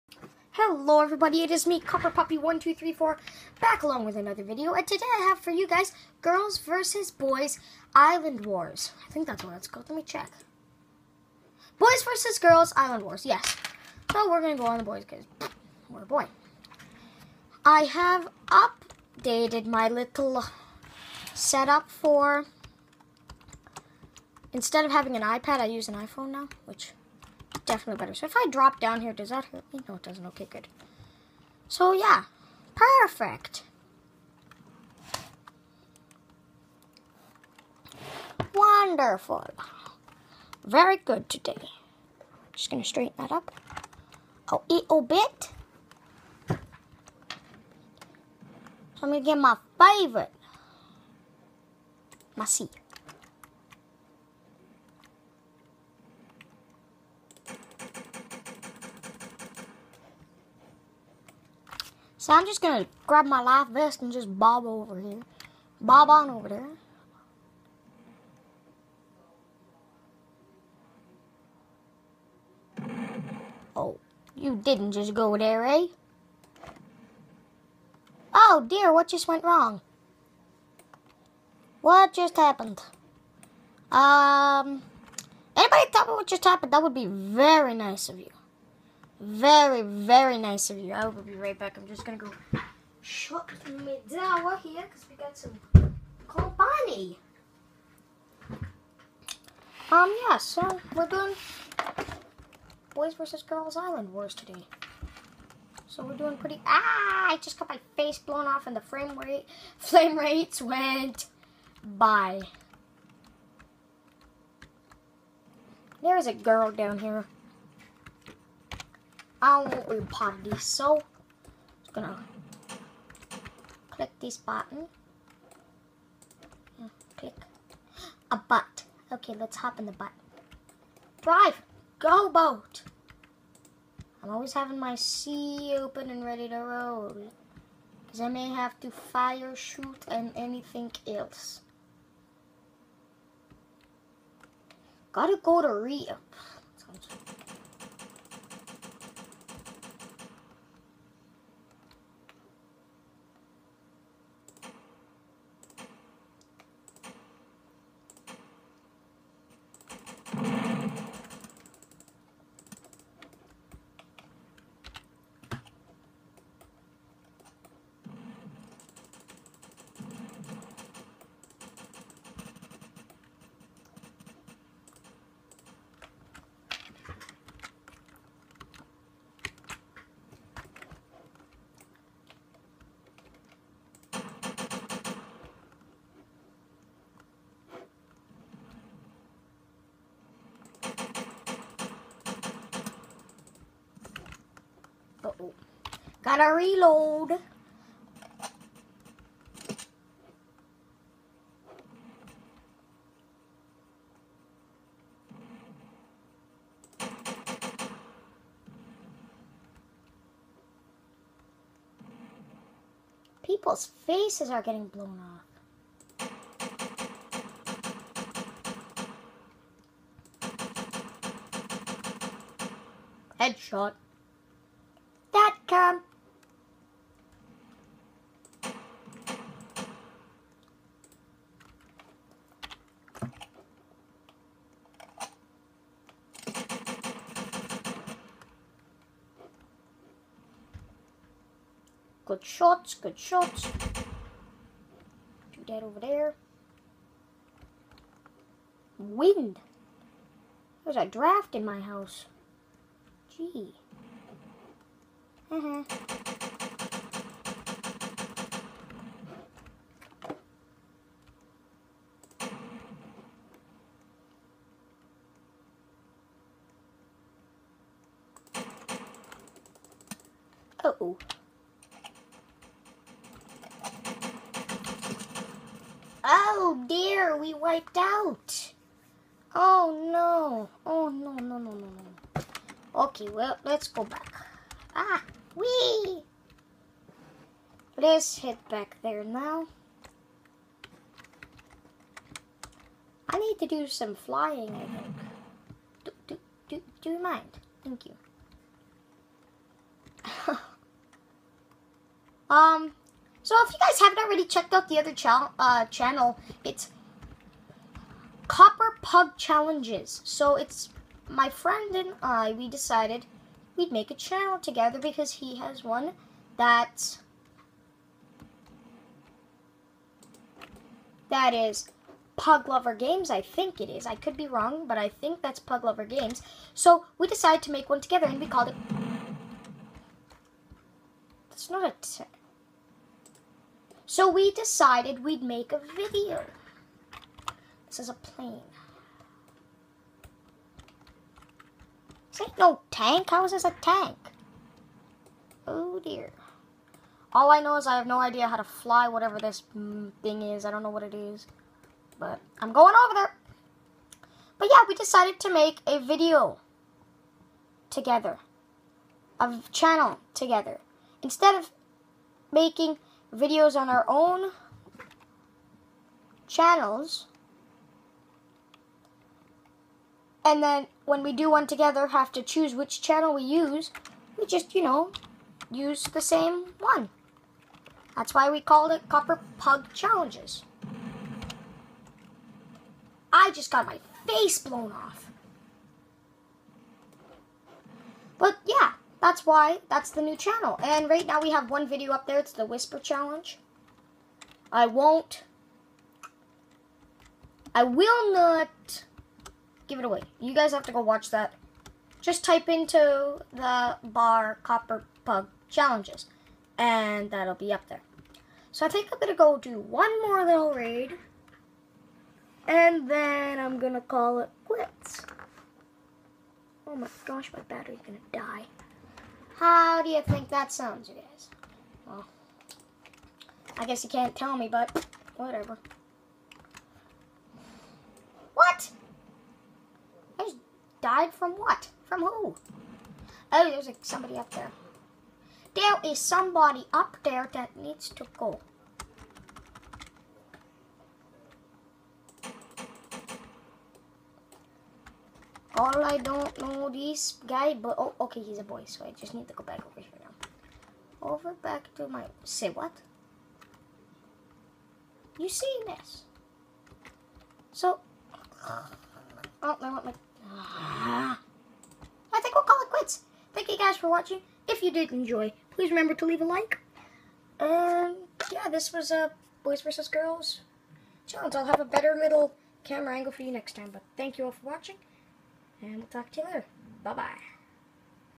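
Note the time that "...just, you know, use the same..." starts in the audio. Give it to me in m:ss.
6:14.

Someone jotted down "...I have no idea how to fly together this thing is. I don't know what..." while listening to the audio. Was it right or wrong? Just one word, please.
wrong.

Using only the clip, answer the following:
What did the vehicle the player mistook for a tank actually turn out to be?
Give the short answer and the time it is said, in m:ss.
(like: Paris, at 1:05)
a plane, at 5:37.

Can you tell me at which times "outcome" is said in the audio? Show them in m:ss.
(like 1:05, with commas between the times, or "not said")
not said.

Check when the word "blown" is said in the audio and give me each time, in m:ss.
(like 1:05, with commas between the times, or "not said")
1:48, 3:34, 6:24.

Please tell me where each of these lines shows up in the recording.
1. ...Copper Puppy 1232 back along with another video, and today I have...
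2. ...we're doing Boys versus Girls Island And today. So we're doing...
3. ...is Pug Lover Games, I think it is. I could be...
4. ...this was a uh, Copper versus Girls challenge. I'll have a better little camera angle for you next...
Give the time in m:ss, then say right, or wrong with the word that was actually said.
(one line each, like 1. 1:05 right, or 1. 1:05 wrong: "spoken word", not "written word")
1. 0:01 wrong: "1234", not "1232"
2. 1:40 wrong: "Wars", not "And"
3. 5:21 right
4. 7:48 wrong: "Boys", not "Copper".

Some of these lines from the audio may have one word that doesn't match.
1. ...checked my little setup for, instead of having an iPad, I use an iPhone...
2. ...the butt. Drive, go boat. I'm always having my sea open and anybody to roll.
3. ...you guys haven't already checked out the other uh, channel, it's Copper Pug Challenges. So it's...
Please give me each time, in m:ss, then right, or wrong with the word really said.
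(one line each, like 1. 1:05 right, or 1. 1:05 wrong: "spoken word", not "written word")
1. 0:18 wrong: "updated", not "checked"
2. 2:09 wrong: "ready", not "anybody"
3. 5:03 right.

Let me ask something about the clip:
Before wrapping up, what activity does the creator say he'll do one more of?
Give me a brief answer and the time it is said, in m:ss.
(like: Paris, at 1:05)
raid, at 6:50.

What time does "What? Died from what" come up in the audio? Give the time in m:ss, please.
7:08.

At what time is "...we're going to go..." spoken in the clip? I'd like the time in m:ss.
0:14.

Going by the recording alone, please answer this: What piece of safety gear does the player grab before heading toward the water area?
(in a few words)
life vest.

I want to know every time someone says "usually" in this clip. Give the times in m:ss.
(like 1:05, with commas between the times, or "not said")
not said.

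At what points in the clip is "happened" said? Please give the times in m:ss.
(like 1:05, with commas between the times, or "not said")
1:22, 1:26.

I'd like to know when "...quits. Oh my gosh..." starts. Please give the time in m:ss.
6:54.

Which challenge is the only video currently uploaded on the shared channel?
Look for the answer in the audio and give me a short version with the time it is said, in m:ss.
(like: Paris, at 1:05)
Whisper Challenge, at 6:32.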